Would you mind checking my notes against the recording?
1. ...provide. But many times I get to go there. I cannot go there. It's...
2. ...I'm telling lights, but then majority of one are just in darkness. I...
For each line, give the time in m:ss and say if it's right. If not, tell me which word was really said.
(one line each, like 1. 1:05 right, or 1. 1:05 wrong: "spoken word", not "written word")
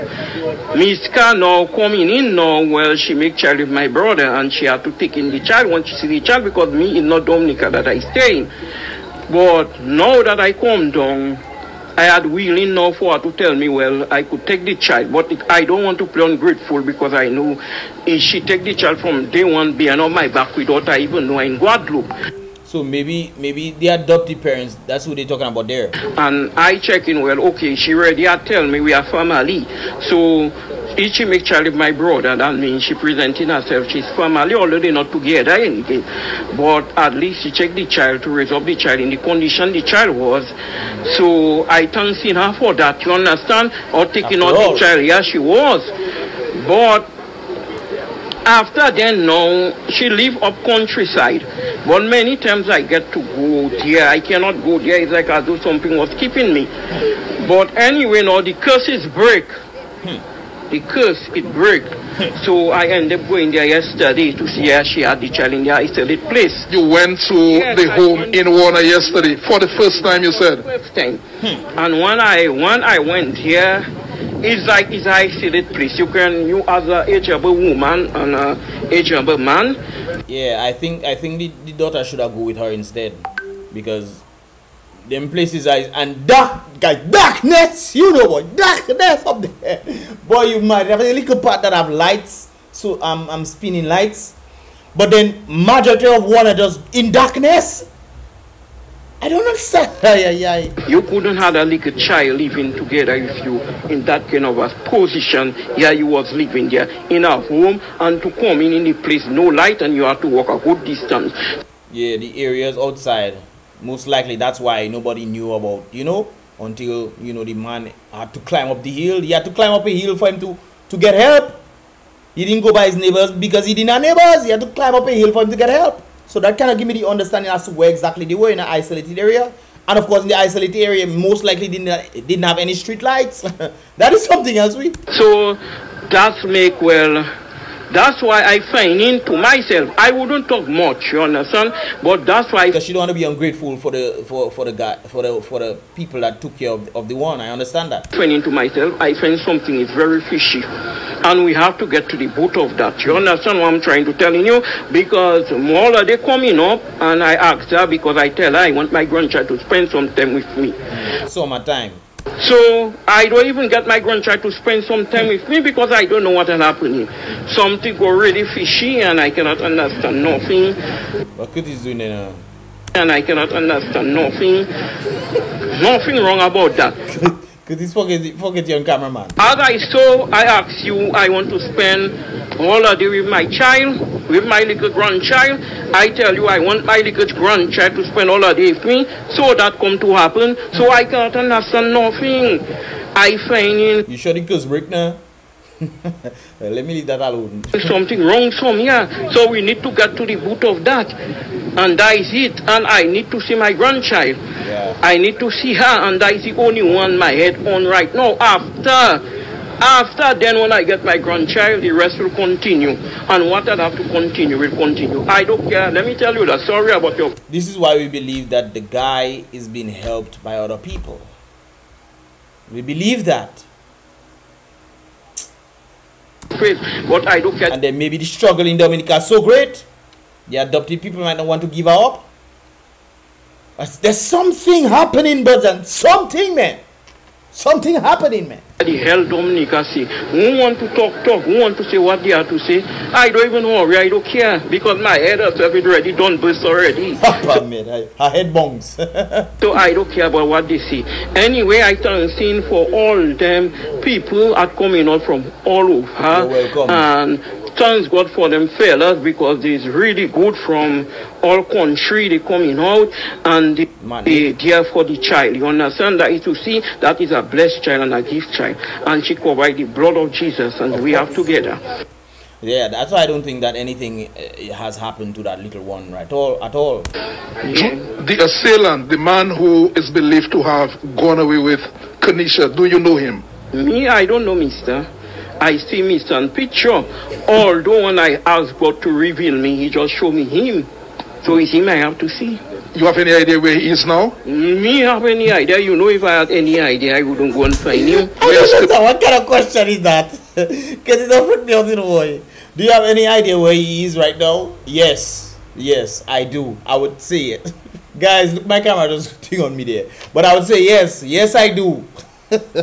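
1. 0:50 wrong: "countryside", not "provide"
2. 1:33 wrong: "spinning", not "telling".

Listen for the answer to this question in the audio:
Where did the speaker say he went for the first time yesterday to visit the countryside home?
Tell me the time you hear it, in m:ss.
1:08.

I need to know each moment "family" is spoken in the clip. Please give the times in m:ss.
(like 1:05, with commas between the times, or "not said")
0:29, 0:34.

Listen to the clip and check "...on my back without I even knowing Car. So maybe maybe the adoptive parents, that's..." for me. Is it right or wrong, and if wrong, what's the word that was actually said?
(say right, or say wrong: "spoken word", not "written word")
wrong: "Guadeloupe", not "Car".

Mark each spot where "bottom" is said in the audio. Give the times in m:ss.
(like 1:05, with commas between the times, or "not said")
2:32.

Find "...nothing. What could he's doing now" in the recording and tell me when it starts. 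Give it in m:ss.
2:50.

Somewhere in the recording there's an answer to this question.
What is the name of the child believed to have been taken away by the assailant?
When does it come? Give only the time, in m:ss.
4:42.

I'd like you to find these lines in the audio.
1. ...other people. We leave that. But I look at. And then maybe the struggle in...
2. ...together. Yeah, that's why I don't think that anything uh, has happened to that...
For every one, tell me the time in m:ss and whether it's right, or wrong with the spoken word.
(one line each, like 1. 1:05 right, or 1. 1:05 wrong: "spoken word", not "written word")
1. 3:40 wrong: "believe", not "leave"
2. 4:31 right.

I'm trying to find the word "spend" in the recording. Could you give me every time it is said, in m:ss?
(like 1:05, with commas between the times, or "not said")
2:39, 2:44, 3:01, 3:08.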